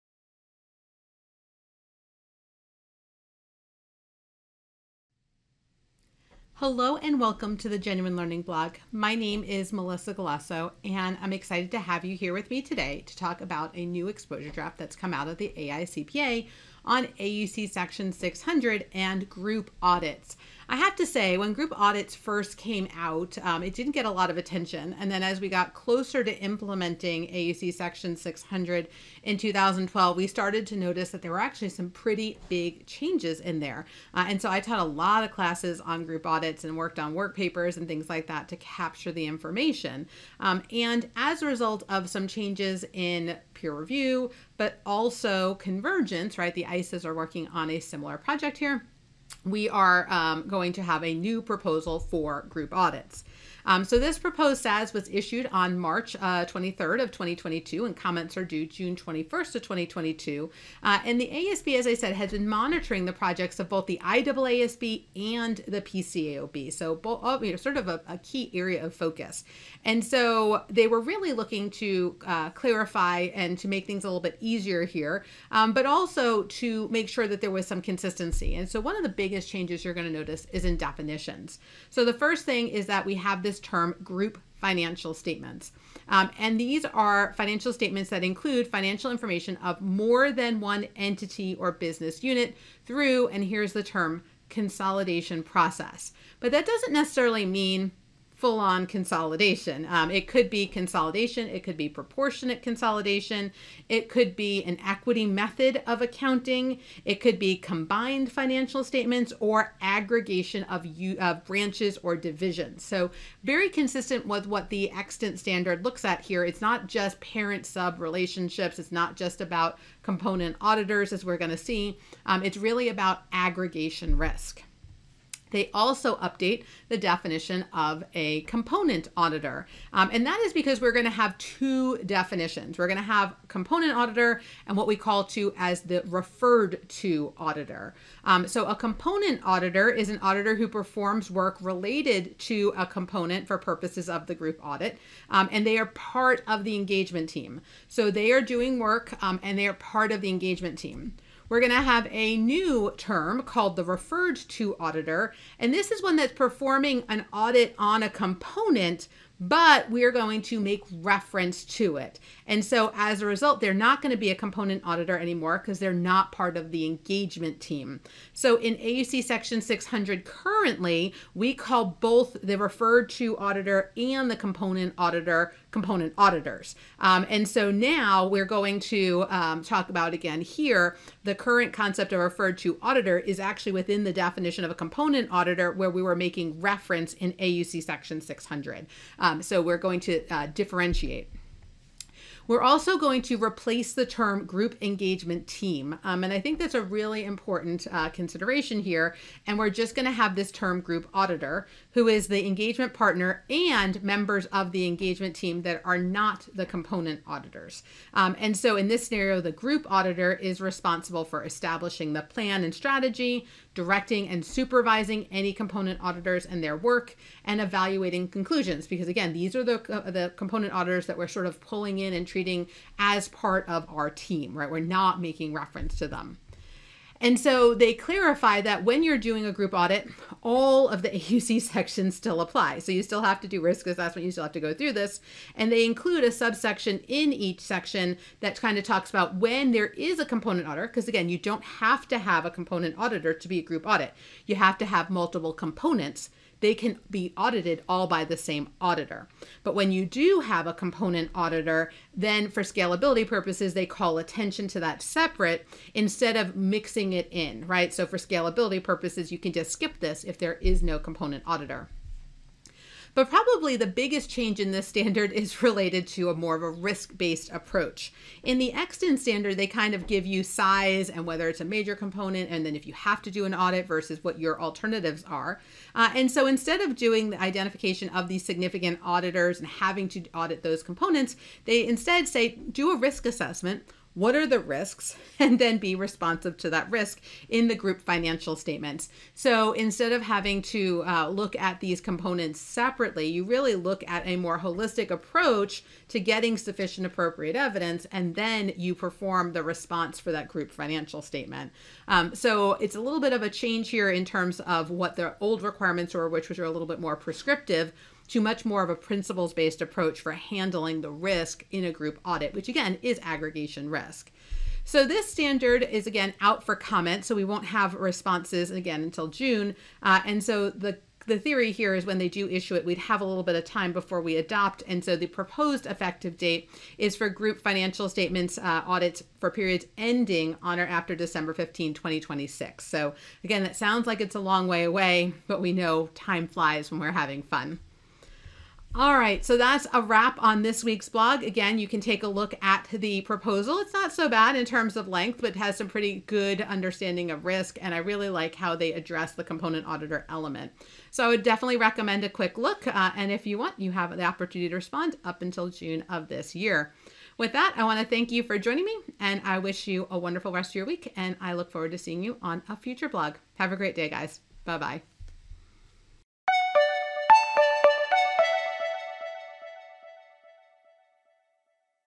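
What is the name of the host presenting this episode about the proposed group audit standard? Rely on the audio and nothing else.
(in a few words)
Melissa Galasso.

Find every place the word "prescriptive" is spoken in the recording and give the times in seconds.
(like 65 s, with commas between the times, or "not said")
307 s.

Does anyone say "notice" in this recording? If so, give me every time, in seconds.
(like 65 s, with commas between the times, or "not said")
30 s, 80 s.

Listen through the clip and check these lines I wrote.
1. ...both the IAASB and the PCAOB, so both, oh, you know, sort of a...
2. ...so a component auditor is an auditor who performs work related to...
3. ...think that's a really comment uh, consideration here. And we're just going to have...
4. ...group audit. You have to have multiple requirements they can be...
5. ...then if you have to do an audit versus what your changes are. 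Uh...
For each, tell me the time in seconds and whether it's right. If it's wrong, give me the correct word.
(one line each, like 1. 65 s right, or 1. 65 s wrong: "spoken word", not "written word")
1. 63 s right
2. 138 s right
3. 196 s wrong: "important", not "comment"
4. 243 s wrong: "components", not "requirements"
5. 272 s wrong: "alternatives", not "changes".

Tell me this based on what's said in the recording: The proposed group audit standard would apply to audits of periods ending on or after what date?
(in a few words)
December 15, 2026.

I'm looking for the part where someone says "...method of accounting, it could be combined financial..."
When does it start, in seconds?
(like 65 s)
105 s.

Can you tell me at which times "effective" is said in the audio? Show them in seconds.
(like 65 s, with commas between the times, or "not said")
325 s.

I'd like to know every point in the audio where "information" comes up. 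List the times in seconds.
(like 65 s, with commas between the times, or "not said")
39 s, 89 s.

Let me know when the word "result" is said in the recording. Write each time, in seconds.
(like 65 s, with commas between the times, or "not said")
41 s, 163 s.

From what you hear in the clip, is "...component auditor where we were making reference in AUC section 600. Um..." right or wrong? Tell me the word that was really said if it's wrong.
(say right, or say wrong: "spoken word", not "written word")
right.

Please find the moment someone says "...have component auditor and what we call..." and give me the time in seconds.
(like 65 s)
133 s.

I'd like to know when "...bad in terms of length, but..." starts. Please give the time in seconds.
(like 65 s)
344 s.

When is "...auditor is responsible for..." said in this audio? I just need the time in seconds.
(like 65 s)
209 s.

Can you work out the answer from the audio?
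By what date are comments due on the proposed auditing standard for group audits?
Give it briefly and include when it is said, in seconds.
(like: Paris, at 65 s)
June 21st of 2022, at 58 s.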